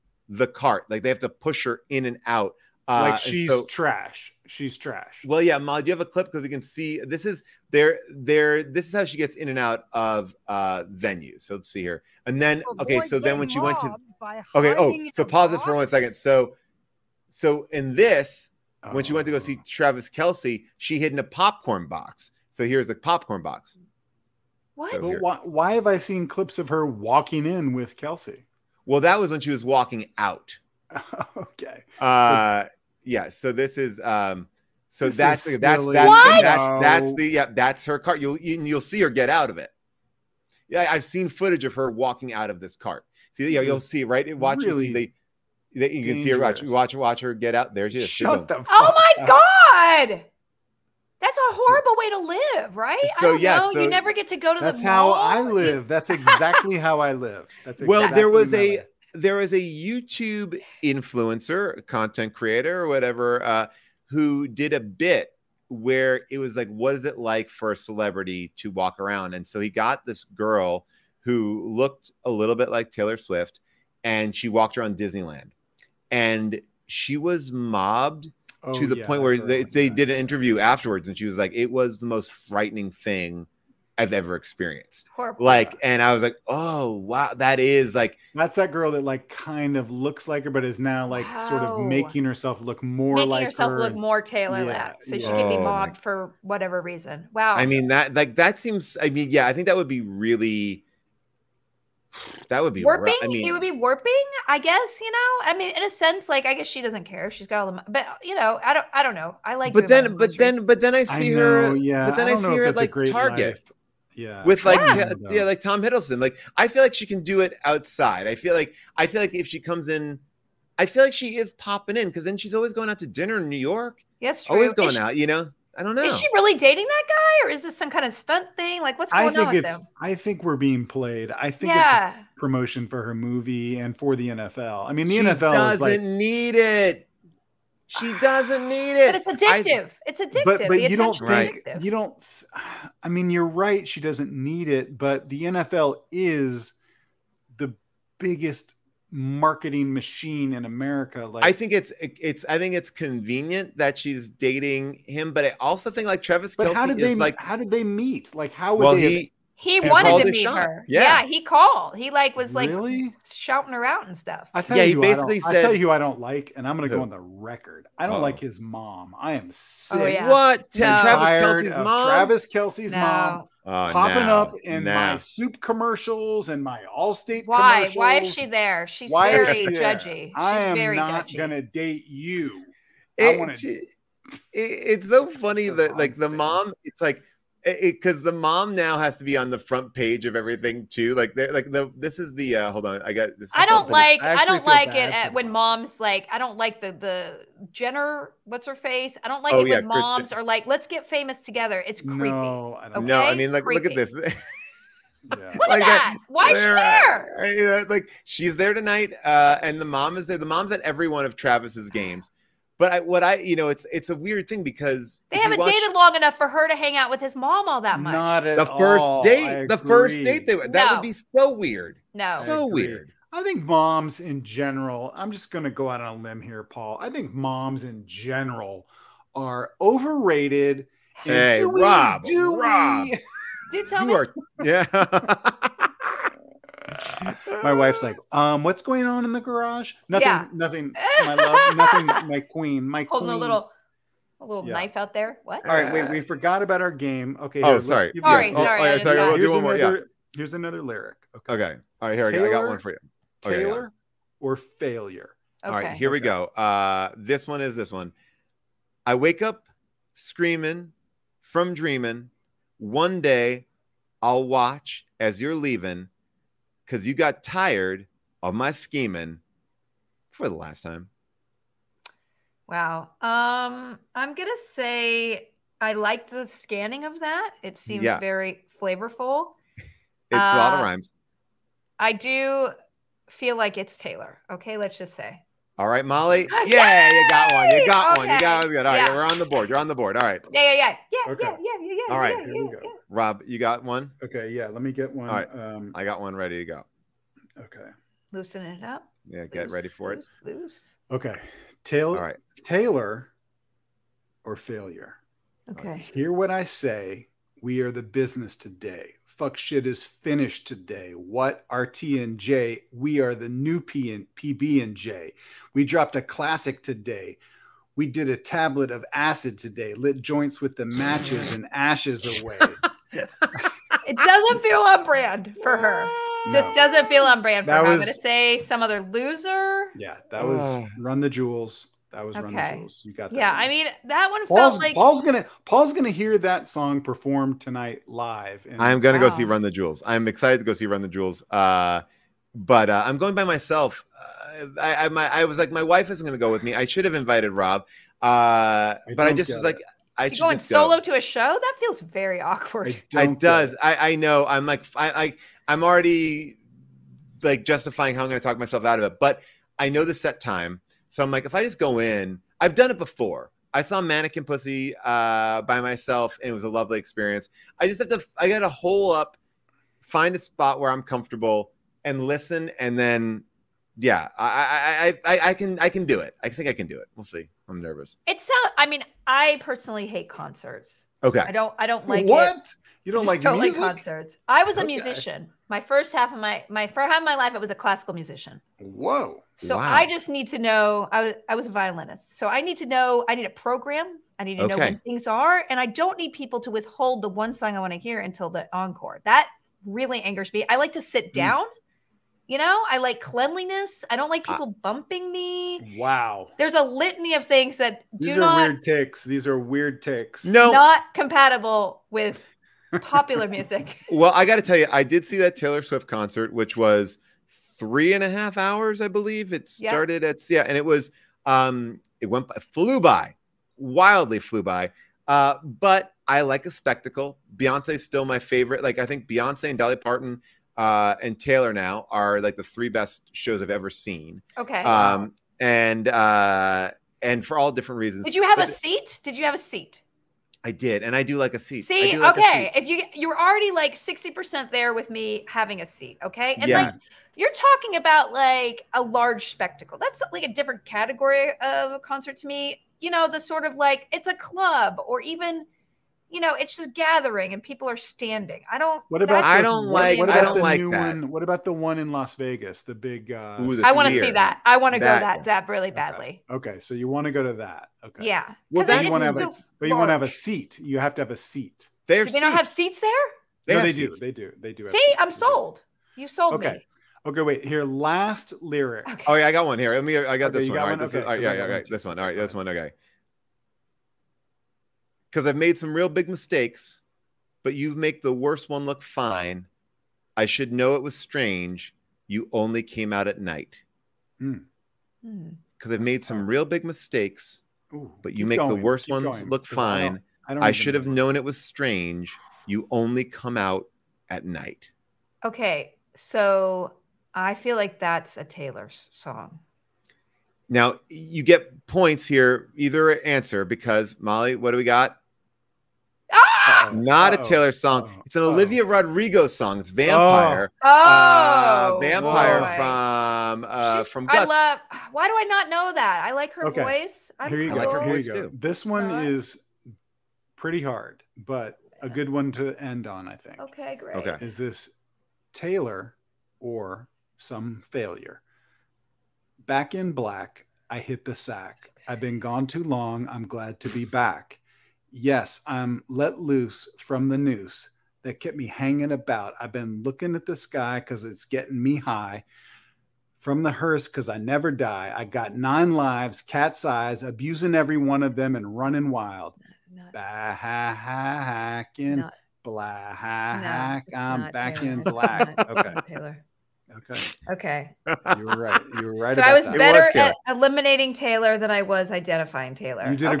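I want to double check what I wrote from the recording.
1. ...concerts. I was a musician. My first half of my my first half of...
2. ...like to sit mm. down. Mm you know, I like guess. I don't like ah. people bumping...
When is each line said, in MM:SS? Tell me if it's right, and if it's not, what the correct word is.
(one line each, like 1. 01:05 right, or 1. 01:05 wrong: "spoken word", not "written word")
1. 06:23 right
2. 06:40 wrong: "cleanliness", not "guess".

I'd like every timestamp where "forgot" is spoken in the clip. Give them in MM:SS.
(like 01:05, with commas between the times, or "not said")
04:06.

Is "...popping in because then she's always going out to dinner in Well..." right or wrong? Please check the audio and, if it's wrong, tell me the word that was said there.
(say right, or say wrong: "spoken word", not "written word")
wrong: "New", not "Well".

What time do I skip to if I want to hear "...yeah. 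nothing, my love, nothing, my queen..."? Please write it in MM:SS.
04:00.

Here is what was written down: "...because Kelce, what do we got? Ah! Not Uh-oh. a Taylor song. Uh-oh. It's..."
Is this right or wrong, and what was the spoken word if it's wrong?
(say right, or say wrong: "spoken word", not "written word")
wrong: "Molly", not "Kelce".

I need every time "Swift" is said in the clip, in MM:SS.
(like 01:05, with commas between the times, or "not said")
01:13, 06:55.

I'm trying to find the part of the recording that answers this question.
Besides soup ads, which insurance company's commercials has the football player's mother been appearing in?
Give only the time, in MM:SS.
02:56.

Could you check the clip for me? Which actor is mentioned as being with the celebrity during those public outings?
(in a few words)
Tom Hiddleston.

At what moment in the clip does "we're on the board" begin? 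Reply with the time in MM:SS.
04:49.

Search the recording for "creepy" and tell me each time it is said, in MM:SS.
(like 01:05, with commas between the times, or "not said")
03:22.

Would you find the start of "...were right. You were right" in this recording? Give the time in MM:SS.
09:28.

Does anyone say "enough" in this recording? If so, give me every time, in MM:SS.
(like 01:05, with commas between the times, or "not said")
03:36.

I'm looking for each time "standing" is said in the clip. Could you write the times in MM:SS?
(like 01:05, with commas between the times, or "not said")
07:37.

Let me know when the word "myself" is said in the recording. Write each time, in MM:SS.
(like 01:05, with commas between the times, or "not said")
05:43, 05:58, 06:05.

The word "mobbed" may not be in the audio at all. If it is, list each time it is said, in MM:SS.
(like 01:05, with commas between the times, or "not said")
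01:17, 01:35.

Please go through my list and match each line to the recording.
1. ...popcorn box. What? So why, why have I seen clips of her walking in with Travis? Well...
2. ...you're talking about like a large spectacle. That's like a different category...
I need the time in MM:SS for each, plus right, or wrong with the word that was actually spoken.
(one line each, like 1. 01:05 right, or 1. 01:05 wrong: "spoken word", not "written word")
1. 00:22 wrong: "Kelsey", not "Travis"
2. 07:27 right.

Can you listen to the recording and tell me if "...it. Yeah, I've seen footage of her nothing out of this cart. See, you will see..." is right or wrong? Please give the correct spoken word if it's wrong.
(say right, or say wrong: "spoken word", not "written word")
wrong: "walking", not "nothing".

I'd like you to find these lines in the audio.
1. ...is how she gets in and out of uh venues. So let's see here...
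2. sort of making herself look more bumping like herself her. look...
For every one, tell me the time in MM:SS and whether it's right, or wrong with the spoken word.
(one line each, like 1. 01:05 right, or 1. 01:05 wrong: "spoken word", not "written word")
1. 00:08 right
2. 01:31 wrong: "making", not "bumping".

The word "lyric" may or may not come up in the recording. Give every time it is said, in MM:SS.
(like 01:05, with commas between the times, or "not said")
04:10, 07:58.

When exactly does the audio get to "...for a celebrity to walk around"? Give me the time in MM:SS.
01:07.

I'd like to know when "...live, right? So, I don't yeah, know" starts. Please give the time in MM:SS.
00:52.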